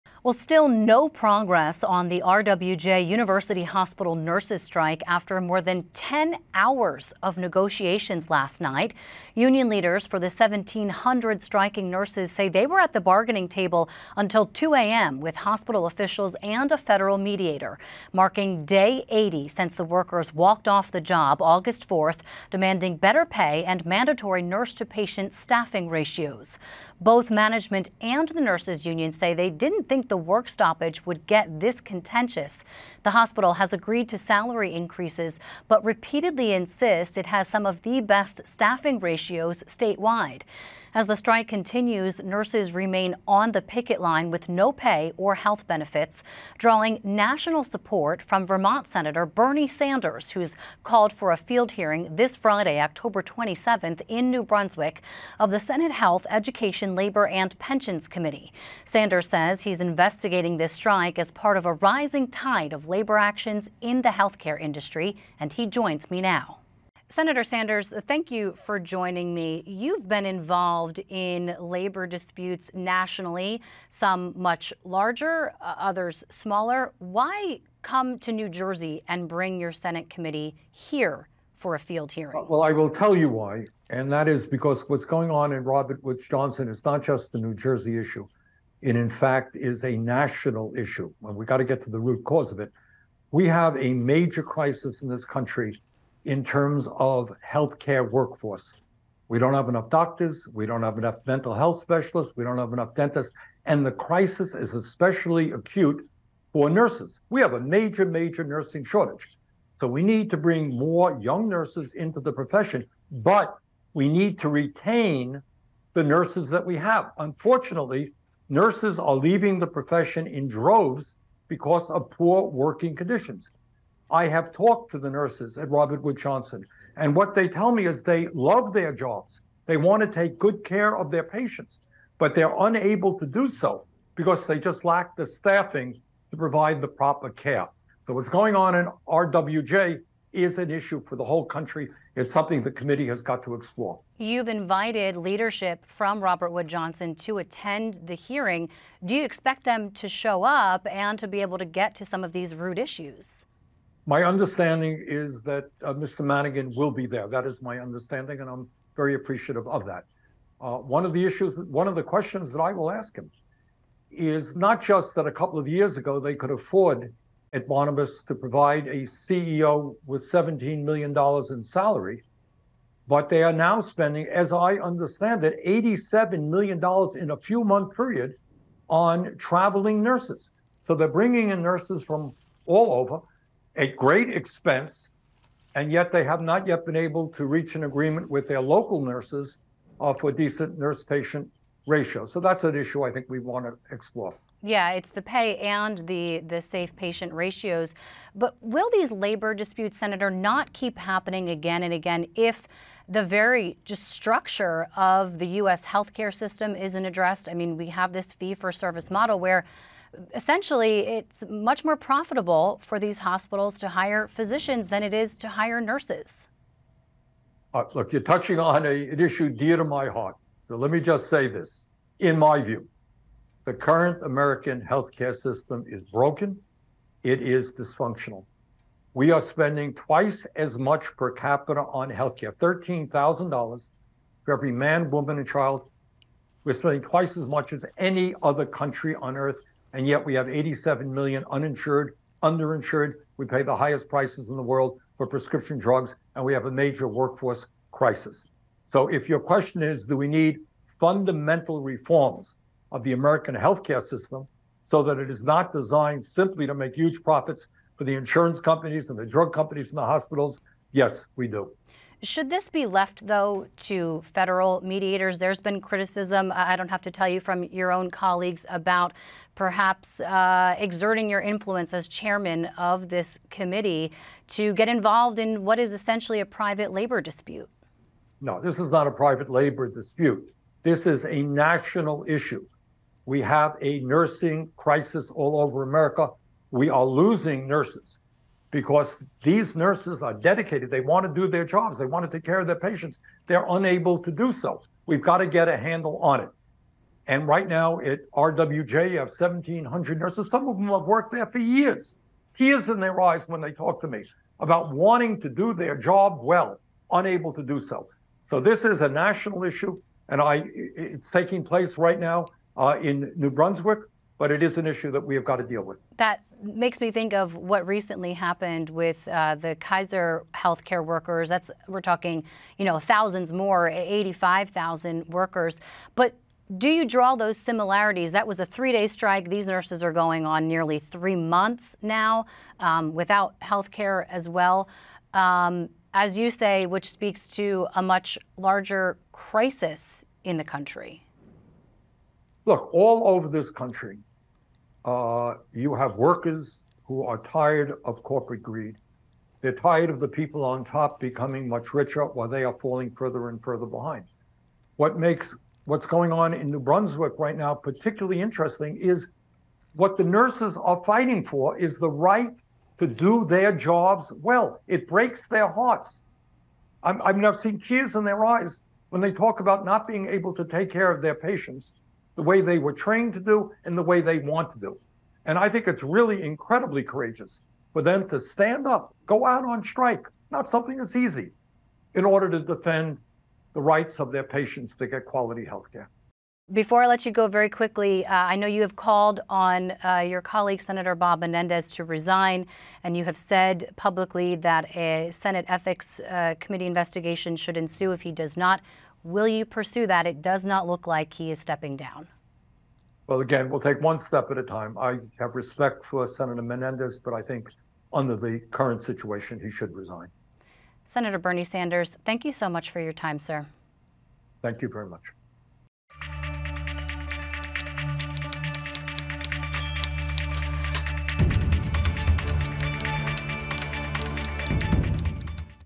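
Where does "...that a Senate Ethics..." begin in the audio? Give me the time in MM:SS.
06:34.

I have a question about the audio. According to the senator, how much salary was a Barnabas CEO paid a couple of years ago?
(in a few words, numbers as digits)
$17 million.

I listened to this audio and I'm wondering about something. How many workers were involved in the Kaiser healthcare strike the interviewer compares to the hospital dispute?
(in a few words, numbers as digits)
85,000.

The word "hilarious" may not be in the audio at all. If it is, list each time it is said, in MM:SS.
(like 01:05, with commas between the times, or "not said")
not said.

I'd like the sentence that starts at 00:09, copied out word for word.
Union leaders for the 1,700 striking nurses say they were at the bargaining table until 2 a.m.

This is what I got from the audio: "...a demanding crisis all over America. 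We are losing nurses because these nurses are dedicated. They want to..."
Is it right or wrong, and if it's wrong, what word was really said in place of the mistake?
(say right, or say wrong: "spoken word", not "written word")
wrong: "nursing", not "demanding".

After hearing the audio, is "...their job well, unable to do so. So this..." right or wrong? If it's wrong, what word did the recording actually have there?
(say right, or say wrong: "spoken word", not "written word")
right.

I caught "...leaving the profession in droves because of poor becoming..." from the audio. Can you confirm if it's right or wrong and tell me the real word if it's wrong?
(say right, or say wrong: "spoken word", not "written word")
wrong: "working", not "becoming".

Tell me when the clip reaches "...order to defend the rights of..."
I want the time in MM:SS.
06:22.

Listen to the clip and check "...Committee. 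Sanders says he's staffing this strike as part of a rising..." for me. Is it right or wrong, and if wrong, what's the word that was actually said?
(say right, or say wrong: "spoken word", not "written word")
wrong: "investigating", not "staffing".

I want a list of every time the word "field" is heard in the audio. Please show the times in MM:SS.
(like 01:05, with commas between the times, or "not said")
00:51, 01:21.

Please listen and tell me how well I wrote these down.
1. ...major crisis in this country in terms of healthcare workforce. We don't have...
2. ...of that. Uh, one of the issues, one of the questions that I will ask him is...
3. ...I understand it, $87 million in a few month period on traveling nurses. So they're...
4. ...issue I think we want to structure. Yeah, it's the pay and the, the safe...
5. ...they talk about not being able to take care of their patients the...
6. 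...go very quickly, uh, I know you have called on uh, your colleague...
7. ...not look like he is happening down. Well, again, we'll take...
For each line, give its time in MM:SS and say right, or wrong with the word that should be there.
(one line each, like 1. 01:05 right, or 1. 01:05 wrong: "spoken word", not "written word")
1. 01:33 right
2. 02:39 right
3. 02:54 right
4. 03:12 wrong: "explore", not "structure"
5. 06:09 right
6. 06:27 right
7. 06:40 wrong: "stepping", not "happening".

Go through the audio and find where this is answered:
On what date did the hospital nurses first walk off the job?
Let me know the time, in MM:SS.
00:21.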